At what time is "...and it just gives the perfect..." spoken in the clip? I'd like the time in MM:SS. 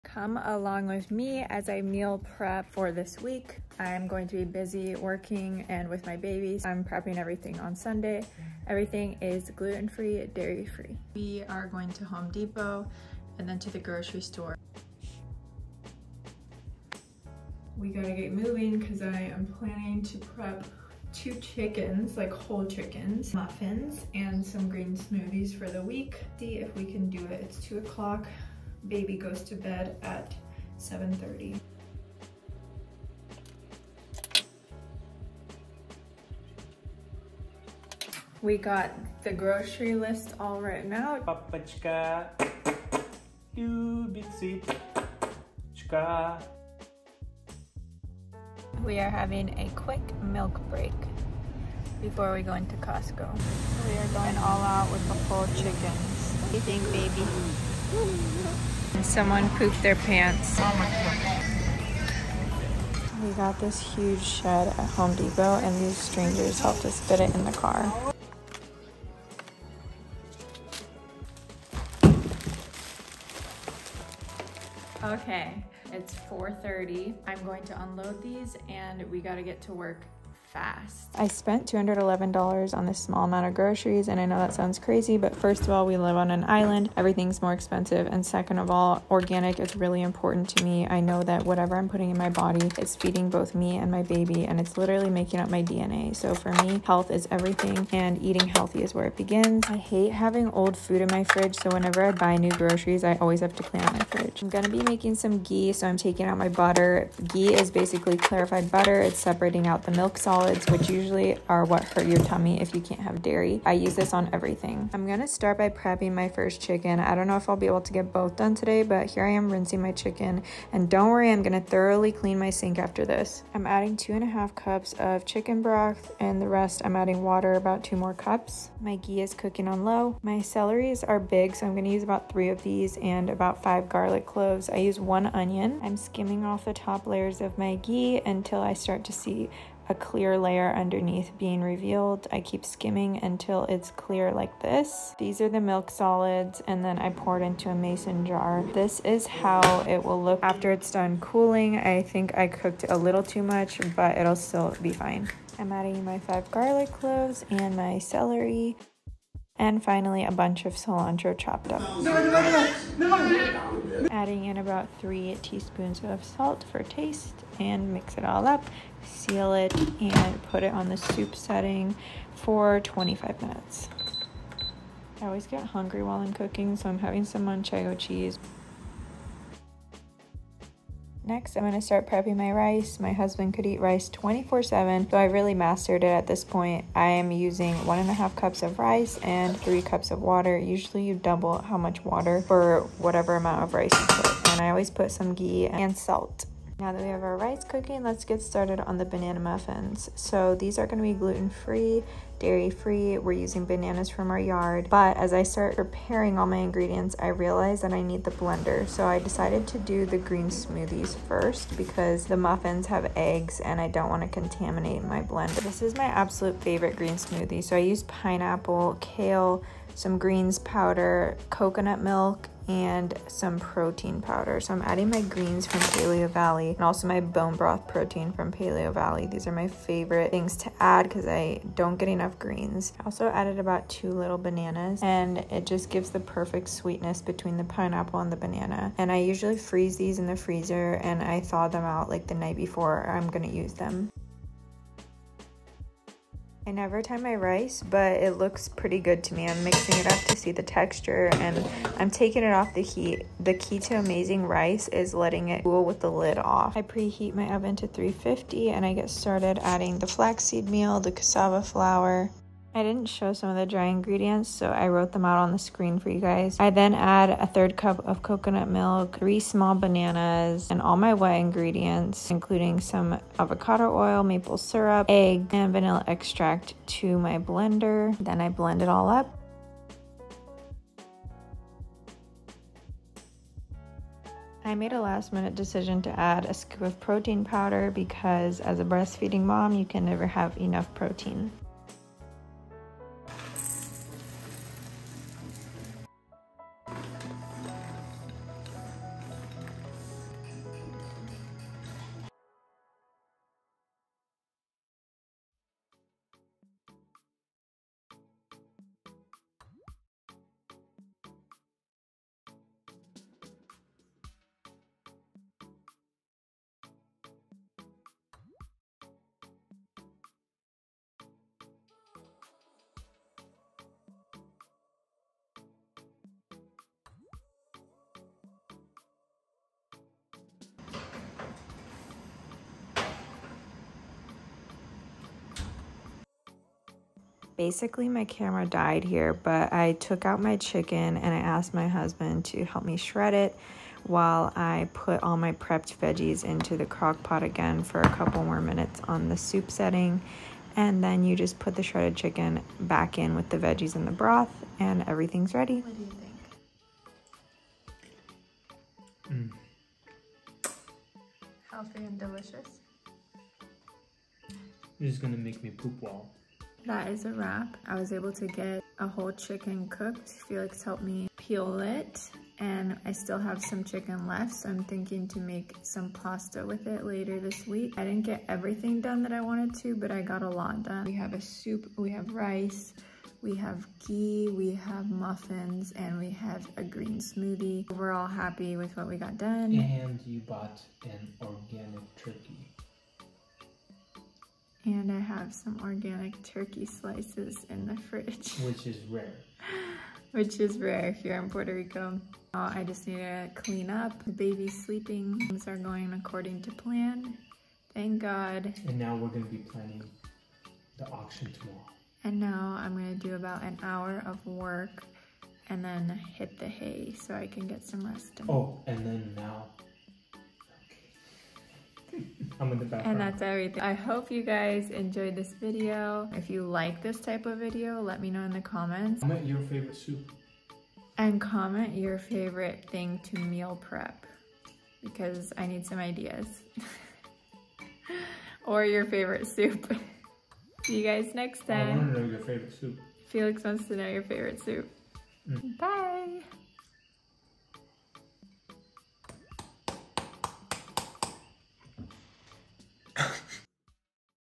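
03:55.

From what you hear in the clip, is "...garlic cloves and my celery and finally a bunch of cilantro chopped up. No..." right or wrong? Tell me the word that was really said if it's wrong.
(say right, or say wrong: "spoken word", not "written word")
right.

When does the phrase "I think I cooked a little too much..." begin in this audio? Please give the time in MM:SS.
02:31.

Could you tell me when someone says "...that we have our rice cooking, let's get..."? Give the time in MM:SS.
03:16.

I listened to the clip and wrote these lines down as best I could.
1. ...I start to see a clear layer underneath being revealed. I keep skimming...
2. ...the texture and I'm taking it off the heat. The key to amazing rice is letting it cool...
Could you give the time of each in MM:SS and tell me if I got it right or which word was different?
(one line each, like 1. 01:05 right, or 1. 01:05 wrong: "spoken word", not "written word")
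1. 02:18 right
2. 04:10 right.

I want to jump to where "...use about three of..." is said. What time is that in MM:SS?
02:11.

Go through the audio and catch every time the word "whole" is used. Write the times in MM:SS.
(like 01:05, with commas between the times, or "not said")
00:22, 00:55, 06:09.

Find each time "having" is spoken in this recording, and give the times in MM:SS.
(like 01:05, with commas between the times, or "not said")
00:49, 01:40, 02:56.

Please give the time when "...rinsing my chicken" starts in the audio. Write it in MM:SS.
01:59.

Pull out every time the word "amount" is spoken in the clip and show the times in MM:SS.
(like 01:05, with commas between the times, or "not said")
01:23, 03:13.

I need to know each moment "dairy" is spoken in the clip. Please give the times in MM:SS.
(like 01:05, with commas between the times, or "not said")
00:10, 01:53, 03:22.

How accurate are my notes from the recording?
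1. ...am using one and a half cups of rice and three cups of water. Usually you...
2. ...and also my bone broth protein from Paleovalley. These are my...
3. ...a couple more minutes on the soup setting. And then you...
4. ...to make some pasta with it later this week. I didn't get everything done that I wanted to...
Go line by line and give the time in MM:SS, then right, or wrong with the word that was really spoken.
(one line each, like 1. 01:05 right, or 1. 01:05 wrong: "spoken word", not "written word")
1. 03:07 right
2. 03:46 right
3. 05:48 right
4. 06:15 right.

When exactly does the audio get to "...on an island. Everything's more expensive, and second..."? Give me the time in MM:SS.
01:26.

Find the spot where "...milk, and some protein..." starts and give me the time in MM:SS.
03:42.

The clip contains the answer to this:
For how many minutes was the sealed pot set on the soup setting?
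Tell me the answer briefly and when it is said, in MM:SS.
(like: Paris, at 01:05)
25 minutes, at 02:52.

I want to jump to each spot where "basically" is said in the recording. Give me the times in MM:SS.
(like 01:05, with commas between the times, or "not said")
01:47, 05:37.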